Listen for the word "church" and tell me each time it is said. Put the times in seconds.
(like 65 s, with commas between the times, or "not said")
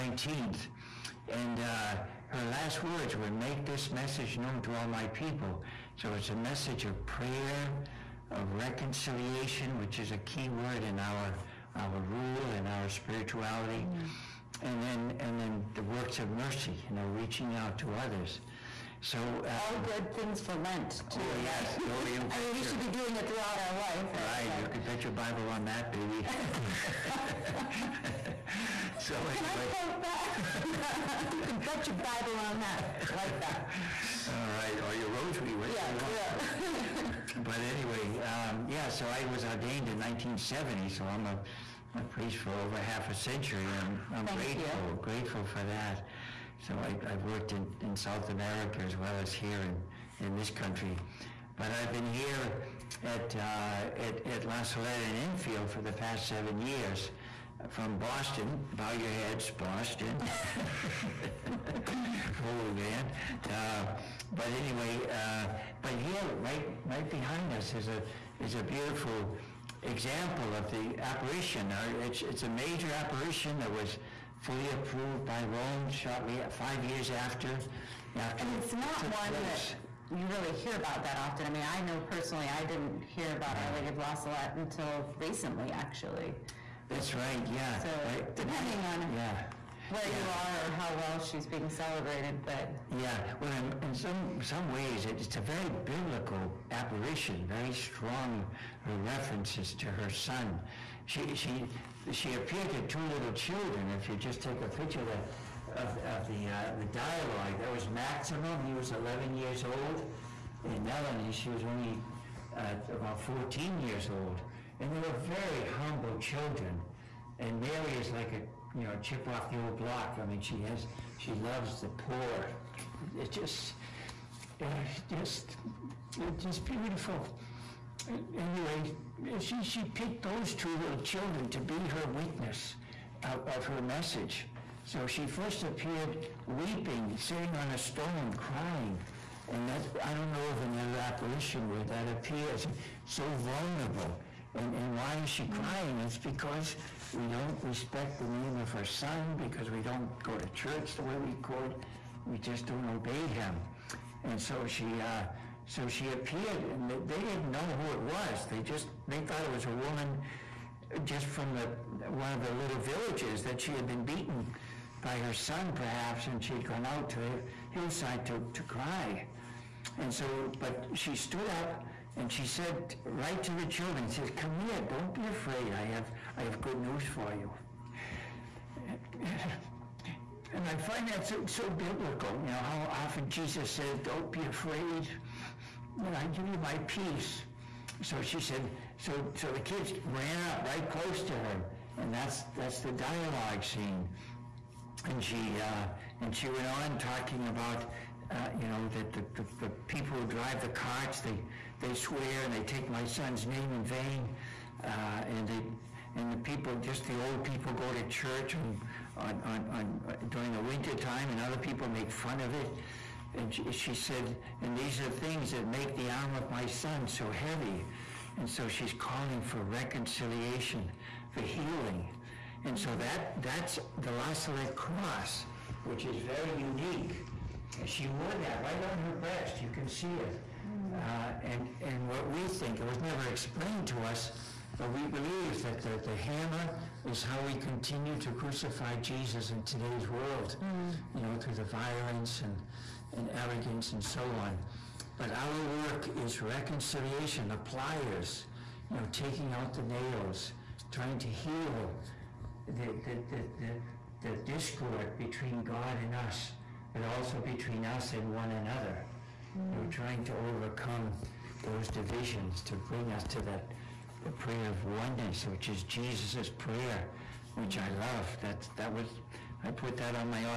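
150 s, 208 s.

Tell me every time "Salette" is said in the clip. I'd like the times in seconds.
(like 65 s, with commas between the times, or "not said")
54 s, 84 s, 224 s.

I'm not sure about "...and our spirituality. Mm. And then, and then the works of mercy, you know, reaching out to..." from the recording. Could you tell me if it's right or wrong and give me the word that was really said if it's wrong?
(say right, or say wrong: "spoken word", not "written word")
right.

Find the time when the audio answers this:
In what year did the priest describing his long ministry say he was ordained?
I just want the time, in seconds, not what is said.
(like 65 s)
39 s.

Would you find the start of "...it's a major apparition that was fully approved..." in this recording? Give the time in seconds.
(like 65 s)
72 s.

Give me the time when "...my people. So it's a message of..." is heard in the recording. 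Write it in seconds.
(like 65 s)
4 s.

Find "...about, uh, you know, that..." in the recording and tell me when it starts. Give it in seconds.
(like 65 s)
197 s.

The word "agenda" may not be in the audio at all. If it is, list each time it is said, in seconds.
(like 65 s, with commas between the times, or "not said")
not said.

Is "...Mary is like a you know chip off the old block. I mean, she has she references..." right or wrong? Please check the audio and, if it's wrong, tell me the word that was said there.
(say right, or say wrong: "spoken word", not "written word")
wrong: "loves", not "references".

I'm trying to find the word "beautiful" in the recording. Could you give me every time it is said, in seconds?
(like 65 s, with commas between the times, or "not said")
68 s, 126 s.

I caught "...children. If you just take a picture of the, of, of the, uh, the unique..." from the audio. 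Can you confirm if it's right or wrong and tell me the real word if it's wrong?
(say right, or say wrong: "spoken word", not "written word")
wrong: "dialogue", not "unique".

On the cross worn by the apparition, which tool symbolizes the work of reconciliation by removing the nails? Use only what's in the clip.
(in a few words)
pliers.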